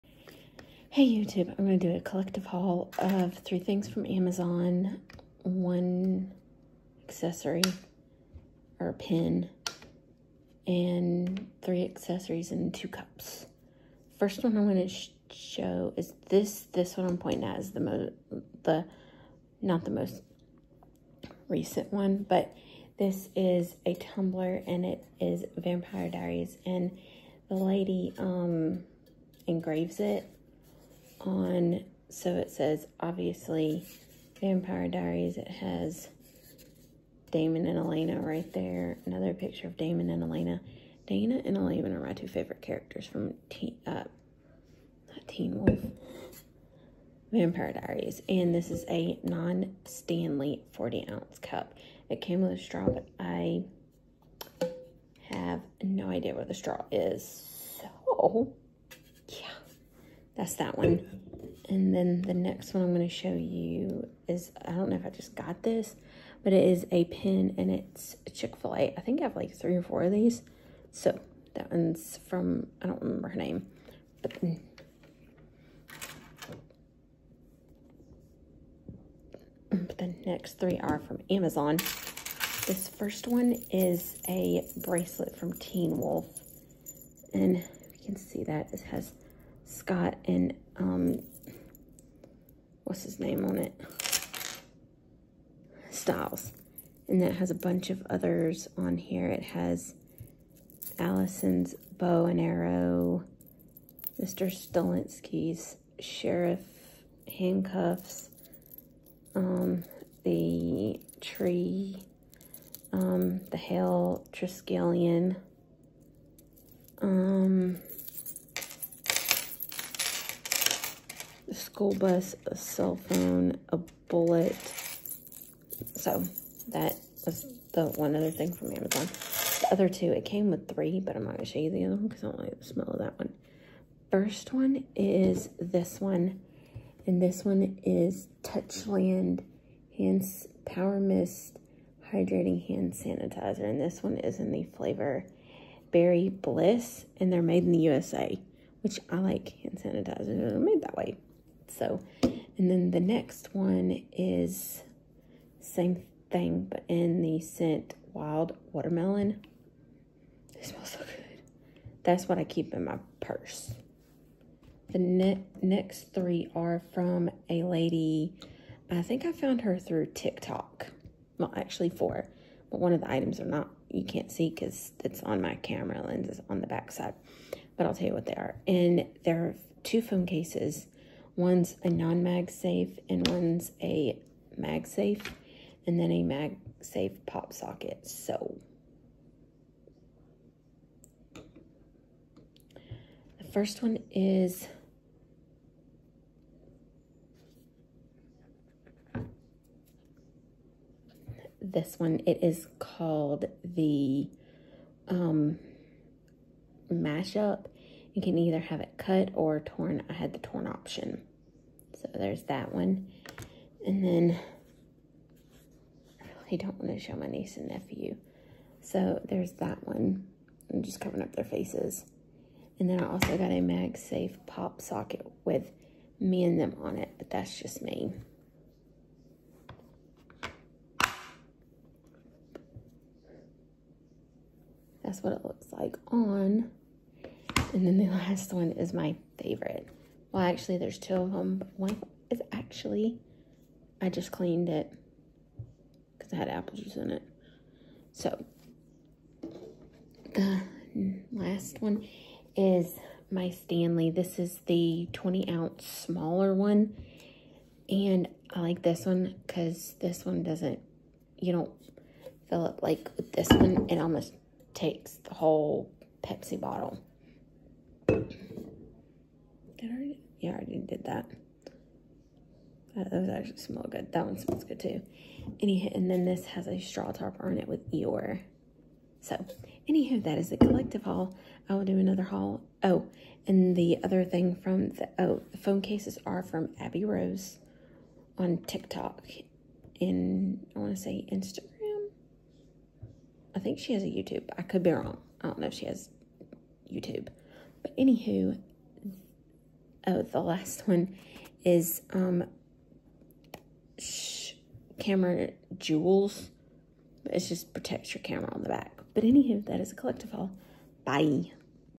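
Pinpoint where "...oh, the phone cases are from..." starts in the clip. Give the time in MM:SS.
04:45.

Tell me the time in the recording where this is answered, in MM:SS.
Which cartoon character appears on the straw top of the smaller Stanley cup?
04:37.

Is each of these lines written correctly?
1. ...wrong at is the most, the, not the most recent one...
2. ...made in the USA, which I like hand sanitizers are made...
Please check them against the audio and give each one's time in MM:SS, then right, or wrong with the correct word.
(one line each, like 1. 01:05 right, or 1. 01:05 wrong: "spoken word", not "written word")
1. 00:17 wrong: "pointing", not "wrong"
2. 02:27 right.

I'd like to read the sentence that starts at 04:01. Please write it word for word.
But one is actually, I just cleaned it because I had apple juice in it.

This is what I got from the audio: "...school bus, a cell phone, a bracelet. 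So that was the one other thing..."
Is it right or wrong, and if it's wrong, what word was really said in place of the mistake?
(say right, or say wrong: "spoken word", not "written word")
wrong: "bullet", not "bracelet".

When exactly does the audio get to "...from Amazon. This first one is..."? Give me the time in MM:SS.
01:21.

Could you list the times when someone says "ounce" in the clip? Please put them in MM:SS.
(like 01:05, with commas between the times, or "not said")
00:50, 04:15.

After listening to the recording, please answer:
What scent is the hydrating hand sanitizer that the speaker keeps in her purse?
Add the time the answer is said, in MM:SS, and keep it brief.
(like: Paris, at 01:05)
Wild Watermelon, at 02:38.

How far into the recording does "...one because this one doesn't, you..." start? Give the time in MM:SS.
04:19.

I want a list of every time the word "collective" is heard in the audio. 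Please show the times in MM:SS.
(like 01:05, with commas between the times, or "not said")
00:02, 04:40, 05:09.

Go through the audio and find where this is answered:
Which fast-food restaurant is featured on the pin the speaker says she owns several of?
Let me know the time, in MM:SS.
01:08.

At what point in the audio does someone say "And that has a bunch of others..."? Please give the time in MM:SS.
01:37.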